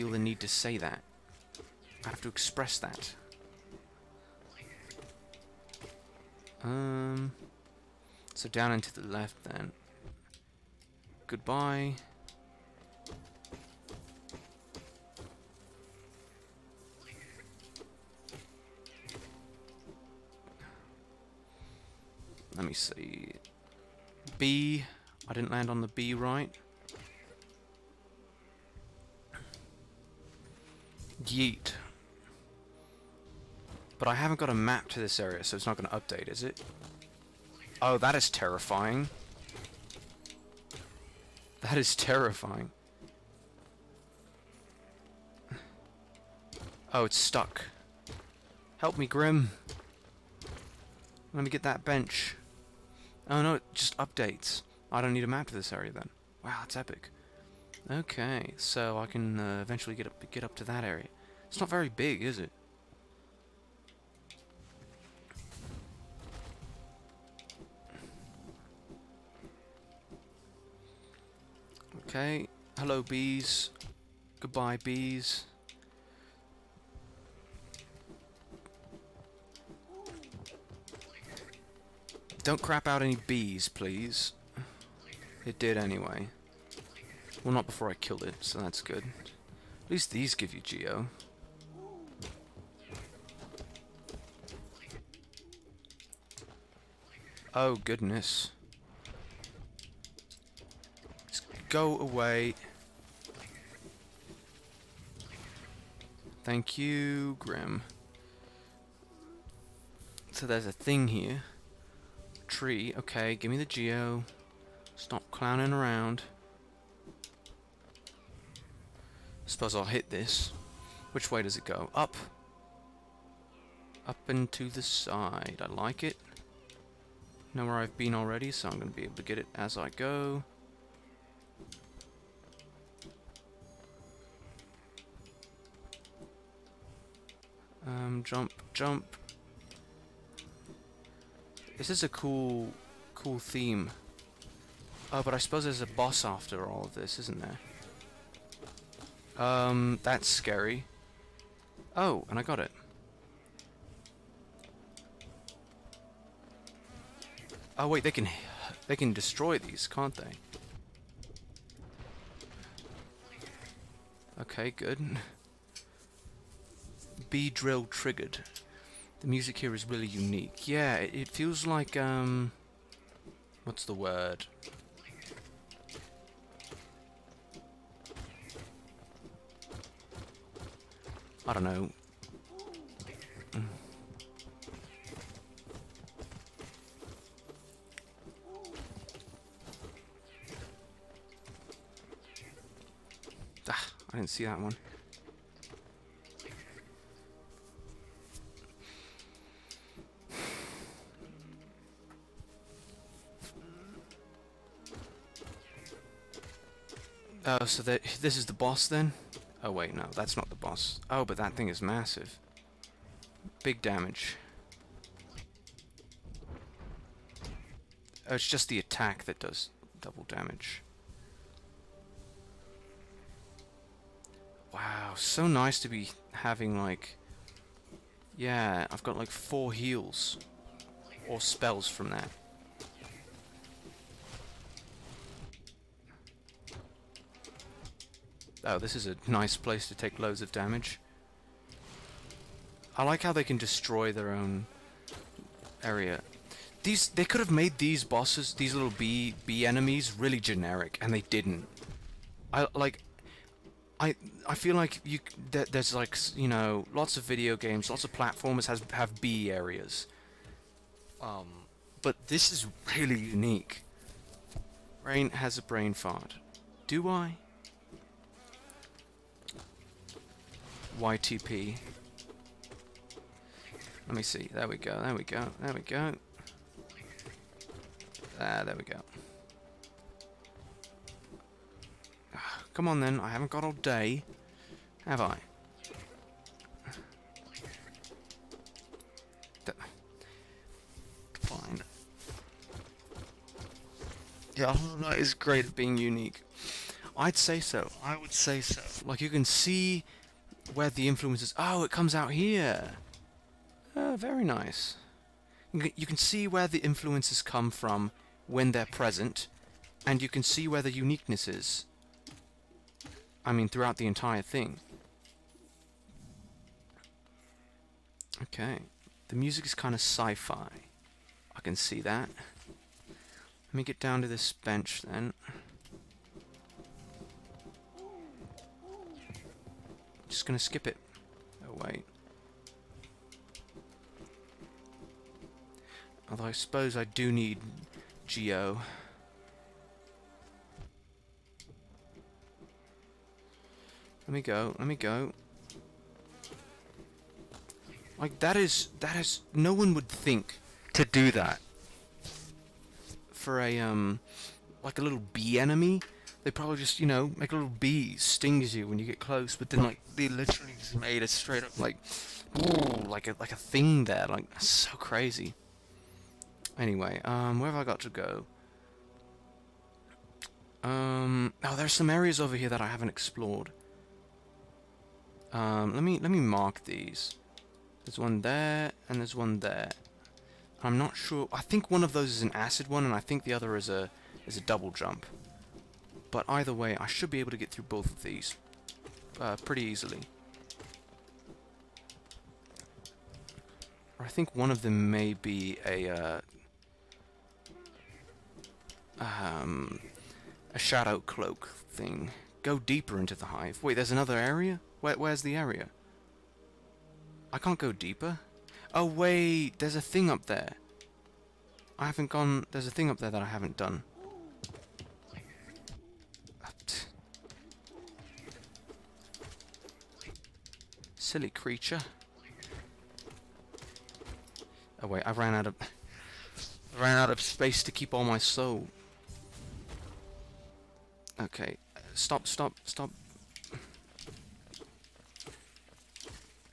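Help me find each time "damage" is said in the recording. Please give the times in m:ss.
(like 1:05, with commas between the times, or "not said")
3:33, 3:40, 4:00.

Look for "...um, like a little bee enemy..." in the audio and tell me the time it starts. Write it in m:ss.
5:53.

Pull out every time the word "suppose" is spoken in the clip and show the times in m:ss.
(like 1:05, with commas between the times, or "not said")
1:59, 2:25, 5:36.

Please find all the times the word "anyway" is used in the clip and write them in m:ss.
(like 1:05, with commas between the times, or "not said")
1:25, 6:06.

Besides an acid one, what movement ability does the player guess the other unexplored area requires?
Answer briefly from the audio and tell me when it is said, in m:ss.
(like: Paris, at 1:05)
Double jump, at 6:24.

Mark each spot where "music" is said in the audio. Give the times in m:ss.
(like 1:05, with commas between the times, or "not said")
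2:49, 5:19.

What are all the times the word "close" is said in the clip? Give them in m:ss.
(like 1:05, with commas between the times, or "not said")
5:59.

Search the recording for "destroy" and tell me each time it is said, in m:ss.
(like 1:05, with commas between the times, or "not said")
2:39, 4:03.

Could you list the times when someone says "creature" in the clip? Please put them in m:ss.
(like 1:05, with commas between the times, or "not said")
7:01.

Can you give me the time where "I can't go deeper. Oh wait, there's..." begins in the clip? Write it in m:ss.
6:47.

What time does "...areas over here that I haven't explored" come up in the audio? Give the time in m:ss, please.
6:12.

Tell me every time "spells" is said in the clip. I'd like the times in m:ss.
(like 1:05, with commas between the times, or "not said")
3:51.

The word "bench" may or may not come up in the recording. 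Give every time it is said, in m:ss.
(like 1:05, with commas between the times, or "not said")
0:51, 5:24.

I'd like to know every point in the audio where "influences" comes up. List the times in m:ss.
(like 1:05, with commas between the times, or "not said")
5:01, 5:06.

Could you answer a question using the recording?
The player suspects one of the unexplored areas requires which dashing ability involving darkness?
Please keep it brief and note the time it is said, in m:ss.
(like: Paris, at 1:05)
Shadow cloak, at 6:40.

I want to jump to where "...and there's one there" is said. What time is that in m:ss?
6:19.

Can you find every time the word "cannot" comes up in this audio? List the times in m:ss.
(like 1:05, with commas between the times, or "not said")
not said.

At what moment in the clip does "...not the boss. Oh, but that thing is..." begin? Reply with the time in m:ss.
3:30.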